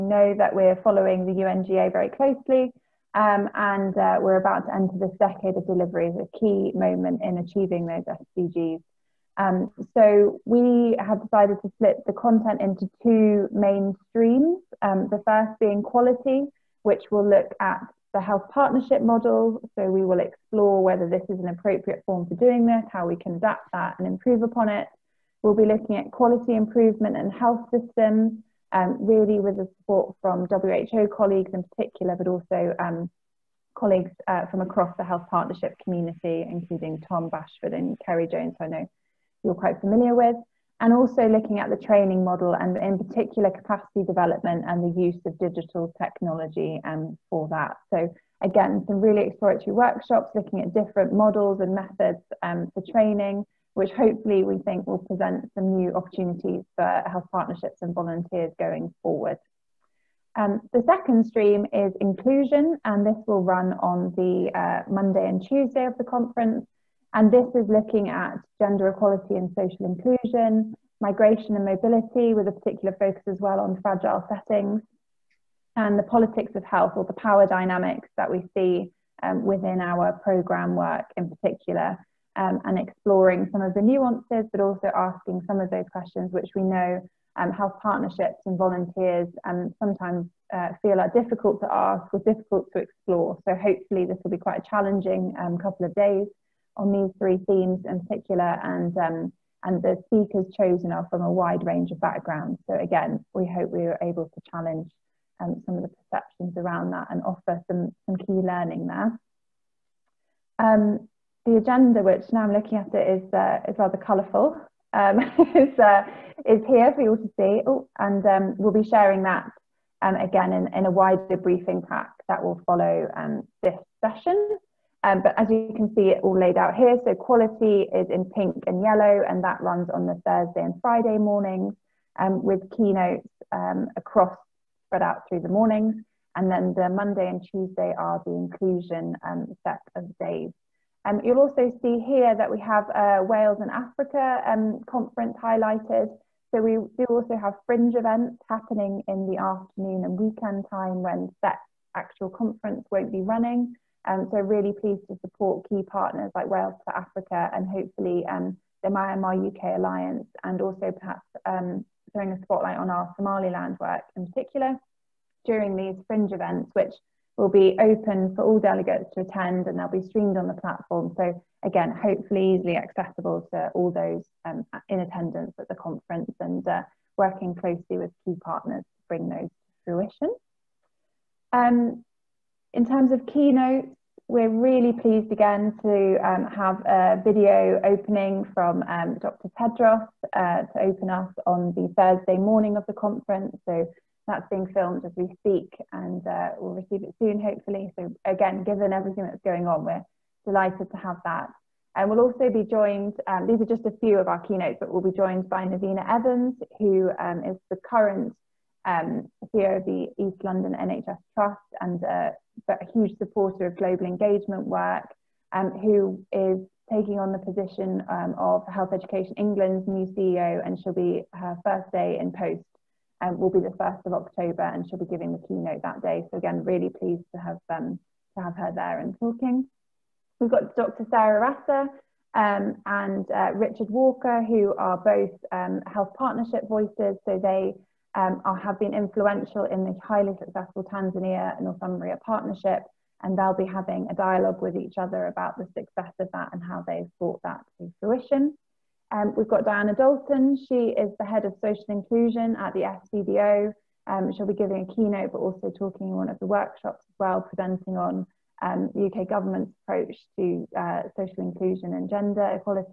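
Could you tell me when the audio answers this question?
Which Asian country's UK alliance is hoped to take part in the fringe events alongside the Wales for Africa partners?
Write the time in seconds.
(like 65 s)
158 s.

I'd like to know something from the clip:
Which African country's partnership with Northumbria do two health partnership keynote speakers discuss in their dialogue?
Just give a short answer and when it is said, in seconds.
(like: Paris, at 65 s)
Tanzania, at 240 s.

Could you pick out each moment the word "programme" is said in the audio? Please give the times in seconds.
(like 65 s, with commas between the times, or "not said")
80 s.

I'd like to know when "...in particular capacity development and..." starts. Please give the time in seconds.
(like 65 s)
42 s.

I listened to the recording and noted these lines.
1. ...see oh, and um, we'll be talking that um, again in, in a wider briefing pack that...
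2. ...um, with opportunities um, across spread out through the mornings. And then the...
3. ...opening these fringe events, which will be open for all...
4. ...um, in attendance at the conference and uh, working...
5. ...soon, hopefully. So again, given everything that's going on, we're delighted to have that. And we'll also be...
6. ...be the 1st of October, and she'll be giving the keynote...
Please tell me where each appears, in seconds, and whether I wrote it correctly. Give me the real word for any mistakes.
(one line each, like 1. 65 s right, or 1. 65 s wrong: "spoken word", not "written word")
1. 117 s wrong: "sharing", not "talking"
2. 132 s wrong: "keynotes", not "opportunities"
3. 165 s wrong: "during", not "opening"
4. 174 s right
5. 197 s right
6. 223 s right.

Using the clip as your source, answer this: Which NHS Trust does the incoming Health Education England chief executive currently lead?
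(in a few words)
East London NHS Trust.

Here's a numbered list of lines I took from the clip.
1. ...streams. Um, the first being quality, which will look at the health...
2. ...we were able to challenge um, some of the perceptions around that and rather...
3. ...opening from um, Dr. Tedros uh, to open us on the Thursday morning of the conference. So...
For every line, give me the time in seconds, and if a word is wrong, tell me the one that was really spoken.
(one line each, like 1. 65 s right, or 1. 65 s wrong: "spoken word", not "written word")
1. 14 s right
2. 103 s wrong: "offer", not "rather"
3. 187 s right.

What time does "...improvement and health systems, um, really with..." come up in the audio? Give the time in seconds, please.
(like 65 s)
26 s.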